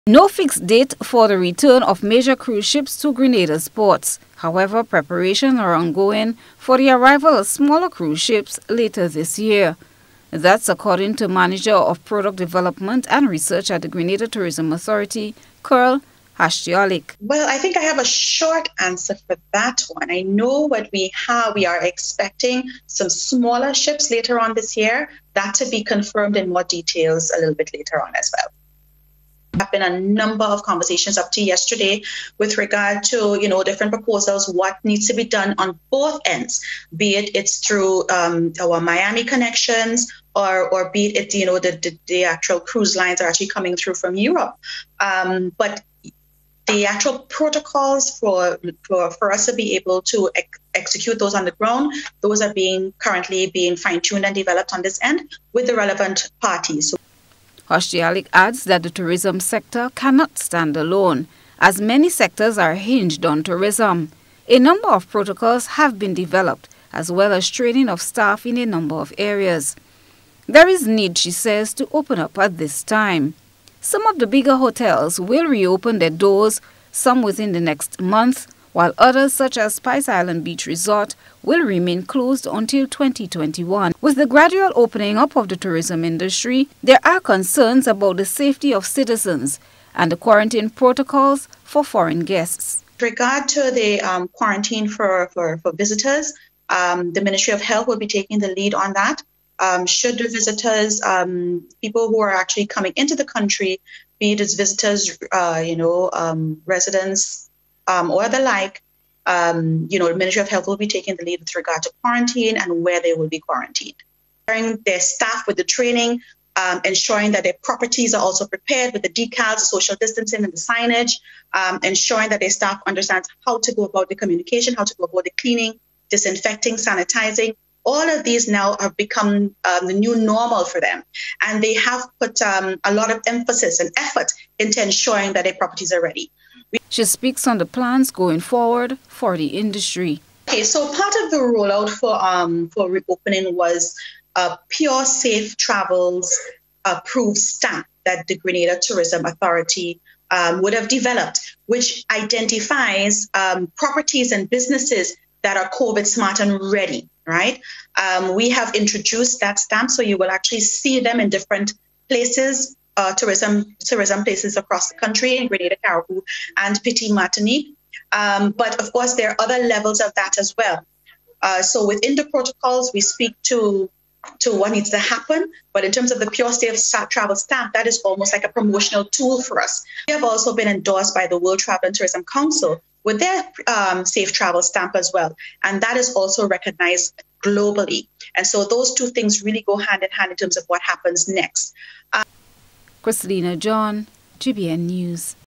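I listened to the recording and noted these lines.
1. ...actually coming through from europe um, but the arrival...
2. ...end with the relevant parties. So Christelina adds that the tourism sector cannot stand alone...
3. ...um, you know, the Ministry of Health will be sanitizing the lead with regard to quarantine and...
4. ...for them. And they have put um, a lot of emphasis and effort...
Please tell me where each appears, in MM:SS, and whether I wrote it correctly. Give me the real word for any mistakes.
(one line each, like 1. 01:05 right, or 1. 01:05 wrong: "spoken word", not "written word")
1. 00:43 wrong: "actual", not "arrival"
2. 00:55 wrong: "Hoschtialek", not "Christelina"
3. 01:49 wrong: "taking", not "sanitizing"
4. 02:10 right.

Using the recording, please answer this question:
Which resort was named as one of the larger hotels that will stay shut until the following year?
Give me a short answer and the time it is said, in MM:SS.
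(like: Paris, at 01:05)
Spice Island Beach Resort, at 01:19.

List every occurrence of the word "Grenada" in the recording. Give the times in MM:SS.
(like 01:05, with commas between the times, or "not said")
00:03, 00:13, 02:28, 02:45.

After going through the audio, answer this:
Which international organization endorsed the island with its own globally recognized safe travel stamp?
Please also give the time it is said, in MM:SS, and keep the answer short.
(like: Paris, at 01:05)
World Travel and Tourism Council, at 03:01.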